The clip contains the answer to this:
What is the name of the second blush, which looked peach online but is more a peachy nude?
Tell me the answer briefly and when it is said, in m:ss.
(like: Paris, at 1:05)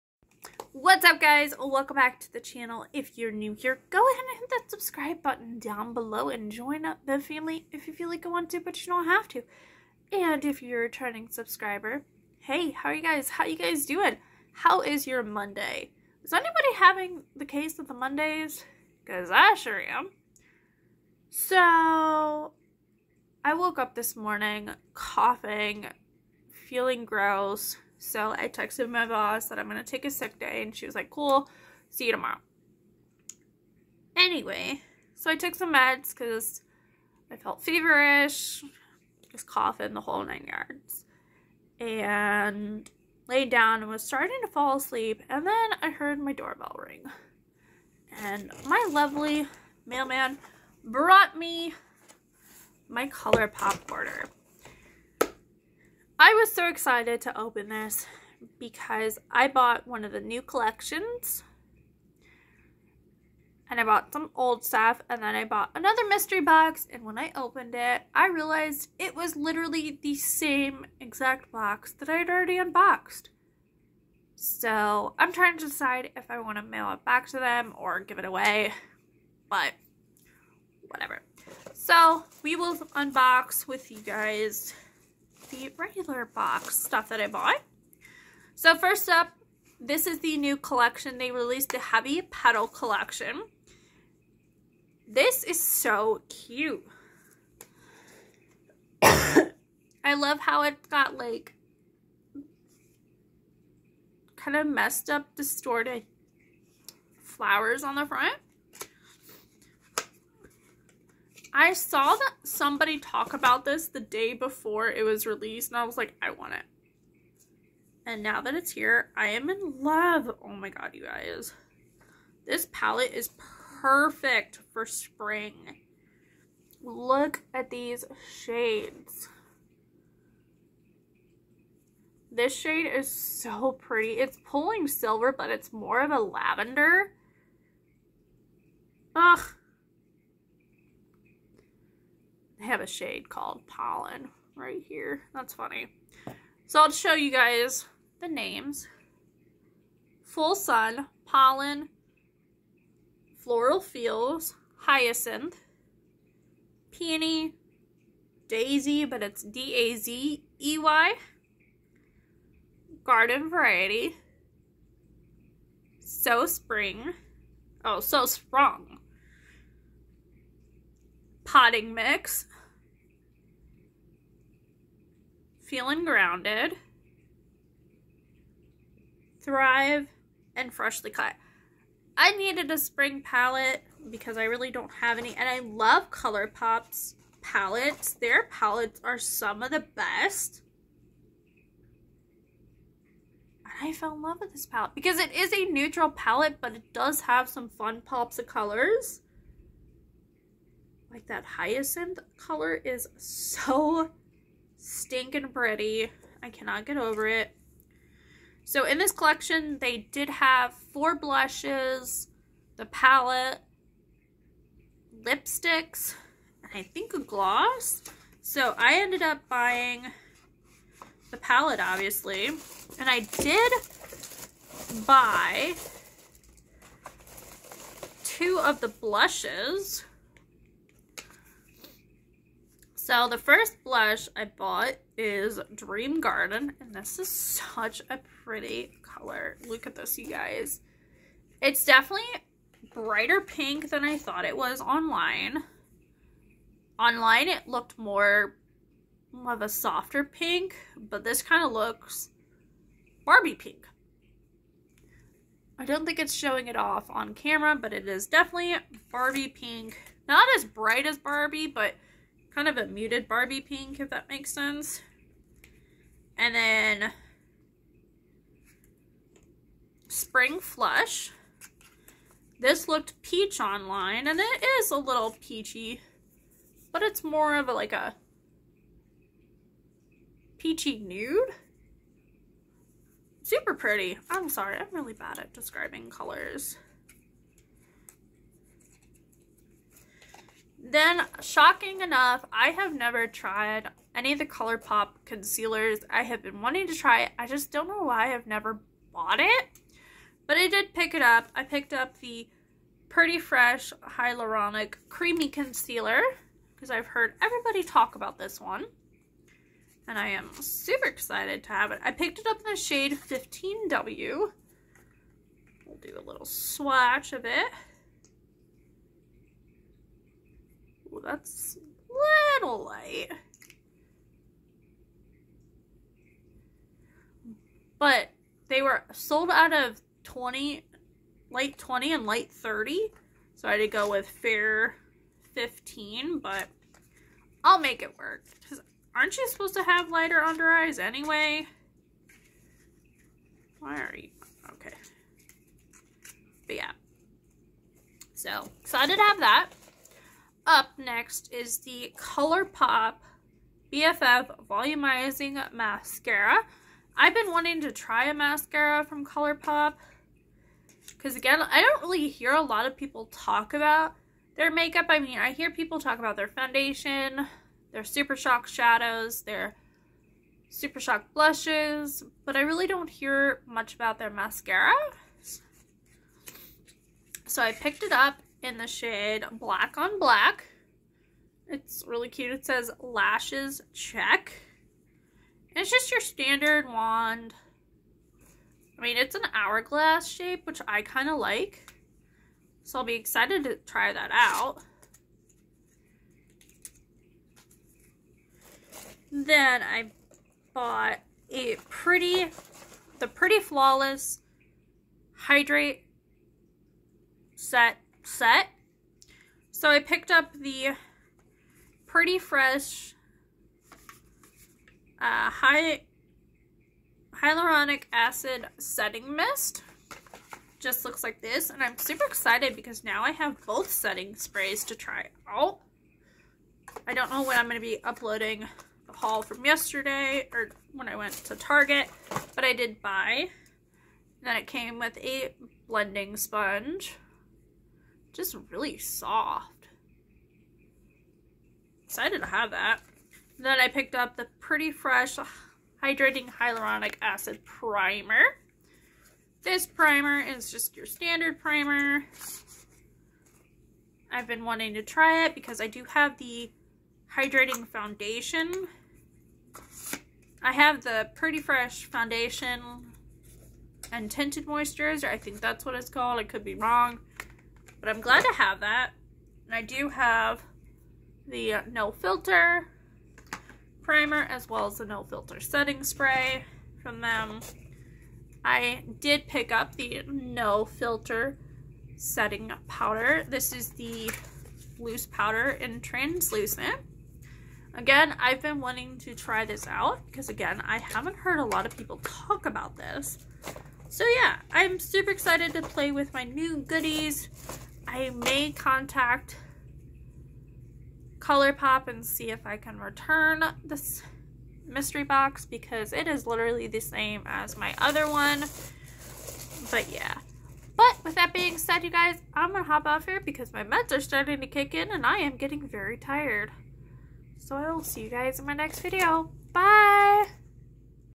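Spring Flush, at 4:30.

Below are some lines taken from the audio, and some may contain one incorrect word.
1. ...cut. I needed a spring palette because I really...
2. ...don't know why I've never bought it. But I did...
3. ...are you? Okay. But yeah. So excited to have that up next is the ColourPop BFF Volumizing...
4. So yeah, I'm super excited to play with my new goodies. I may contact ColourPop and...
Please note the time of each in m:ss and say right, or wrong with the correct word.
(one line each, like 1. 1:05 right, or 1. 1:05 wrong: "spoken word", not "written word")
1. 3:01 right
2. 4:57 right
3. 5:44 right
4. 8:14 right.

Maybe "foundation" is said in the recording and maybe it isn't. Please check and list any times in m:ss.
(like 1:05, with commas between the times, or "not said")
6:06, 7:37, 7:42.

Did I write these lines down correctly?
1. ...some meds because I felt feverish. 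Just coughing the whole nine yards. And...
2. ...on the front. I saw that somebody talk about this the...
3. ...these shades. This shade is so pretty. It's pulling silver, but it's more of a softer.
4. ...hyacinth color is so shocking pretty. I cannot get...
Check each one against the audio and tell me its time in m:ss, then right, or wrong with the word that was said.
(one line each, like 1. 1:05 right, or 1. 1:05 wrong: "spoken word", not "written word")
1. 0:35 right
2. 1:47 right
3. 2:07 wrong: "lavender", not "softer"
4. 3:21 wrong: "stinking", not "shocking".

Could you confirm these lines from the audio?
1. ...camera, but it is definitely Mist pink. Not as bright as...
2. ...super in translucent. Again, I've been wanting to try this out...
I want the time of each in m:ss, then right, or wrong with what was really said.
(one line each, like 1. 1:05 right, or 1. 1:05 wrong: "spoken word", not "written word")
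1. 4:17 wrong: "Barbie", not "Mist"
2. 8:05 wrong: "powder", not "super".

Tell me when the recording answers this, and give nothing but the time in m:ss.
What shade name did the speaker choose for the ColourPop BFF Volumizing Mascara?
6:19.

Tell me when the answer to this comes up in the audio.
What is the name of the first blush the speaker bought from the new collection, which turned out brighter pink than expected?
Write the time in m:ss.
3:55.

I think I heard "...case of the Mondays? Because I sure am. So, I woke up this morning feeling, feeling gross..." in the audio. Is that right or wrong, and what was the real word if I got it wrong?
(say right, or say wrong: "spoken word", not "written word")
wrong: "coughing", not "feeling".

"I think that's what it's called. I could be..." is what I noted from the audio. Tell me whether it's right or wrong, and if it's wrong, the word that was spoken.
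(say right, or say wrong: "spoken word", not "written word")
right.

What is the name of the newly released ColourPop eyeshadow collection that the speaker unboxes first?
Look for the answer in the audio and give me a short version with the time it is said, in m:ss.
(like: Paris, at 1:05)
Heavy Petal, at 1:31.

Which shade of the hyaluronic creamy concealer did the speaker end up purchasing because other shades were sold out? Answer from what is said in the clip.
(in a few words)
15W.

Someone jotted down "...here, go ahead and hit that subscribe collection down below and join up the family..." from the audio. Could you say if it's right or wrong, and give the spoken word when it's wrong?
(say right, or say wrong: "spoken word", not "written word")
wrong: "button", not "collection".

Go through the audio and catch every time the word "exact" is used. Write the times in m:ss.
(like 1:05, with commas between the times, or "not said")
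1:10.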